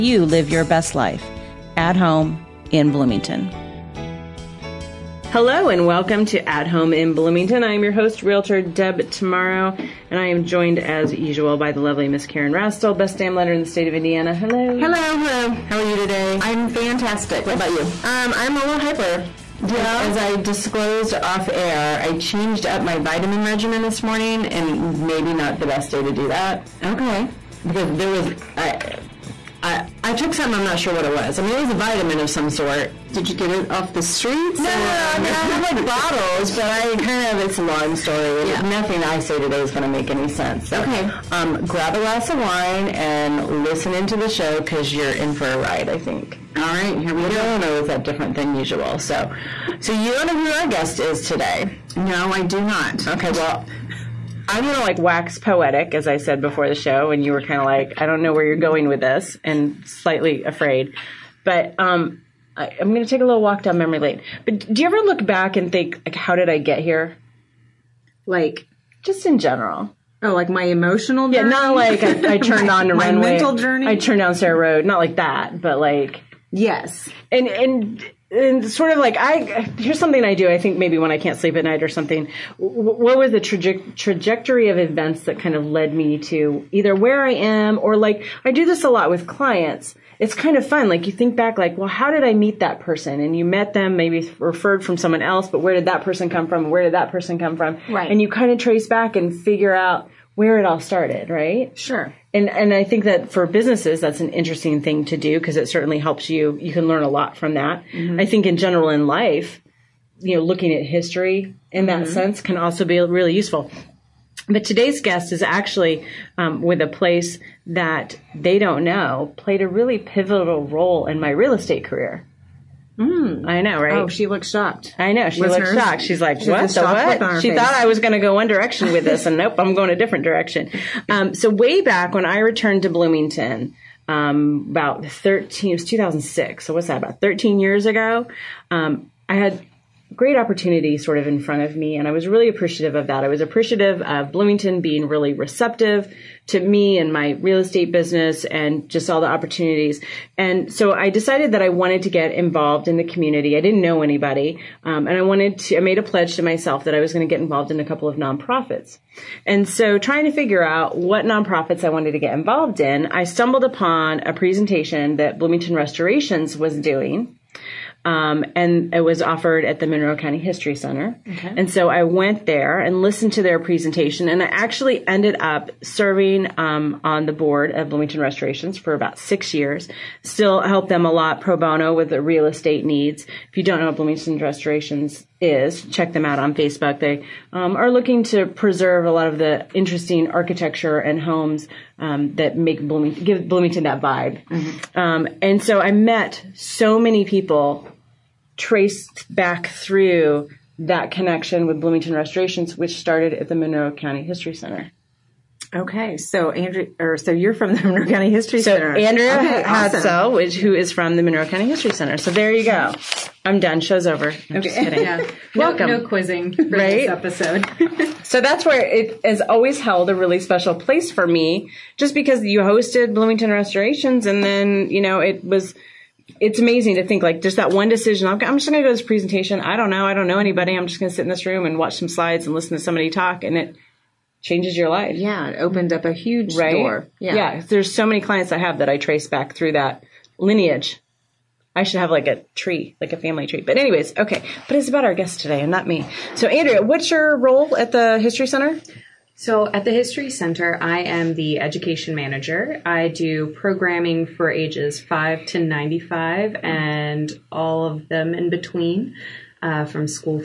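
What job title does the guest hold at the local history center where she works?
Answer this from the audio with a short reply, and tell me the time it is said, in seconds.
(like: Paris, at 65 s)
Education manager, at 251 s.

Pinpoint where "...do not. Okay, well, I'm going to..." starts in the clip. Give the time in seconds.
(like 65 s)
52 s.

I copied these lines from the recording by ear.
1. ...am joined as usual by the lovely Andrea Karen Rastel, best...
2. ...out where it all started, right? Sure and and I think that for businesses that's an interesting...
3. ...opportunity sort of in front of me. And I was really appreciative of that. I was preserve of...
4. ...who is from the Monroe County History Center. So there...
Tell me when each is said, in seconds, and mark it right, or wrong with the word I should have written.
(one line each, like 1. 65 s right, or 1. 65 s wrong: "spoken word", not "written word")
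1. 10 s wrong: "Miss", not "Andrea"
2. 99 s right
3. 140 s wrong: "appreciative", not "preserve"
4. 210 s right.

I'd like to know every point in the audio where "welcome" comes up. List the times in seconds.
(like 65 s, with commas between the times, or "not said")
5 s, 215 s.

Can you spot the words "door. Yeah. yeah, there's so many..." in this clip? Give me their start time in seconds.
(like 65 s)
236 s.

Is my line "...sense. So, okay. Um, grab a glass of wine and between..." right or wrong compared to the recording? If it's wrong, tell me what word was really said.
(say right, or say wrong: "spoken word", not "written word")
wrong: "listen", not "between".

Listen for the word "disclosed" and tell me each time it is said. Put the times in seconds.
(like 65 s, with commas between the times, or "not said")
20 s.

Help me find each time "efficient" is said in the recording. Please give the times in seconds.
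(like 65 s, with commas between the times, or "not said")
not said.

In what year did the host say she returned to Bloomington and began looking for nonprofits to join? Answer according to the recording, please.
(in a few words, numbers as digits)
2006.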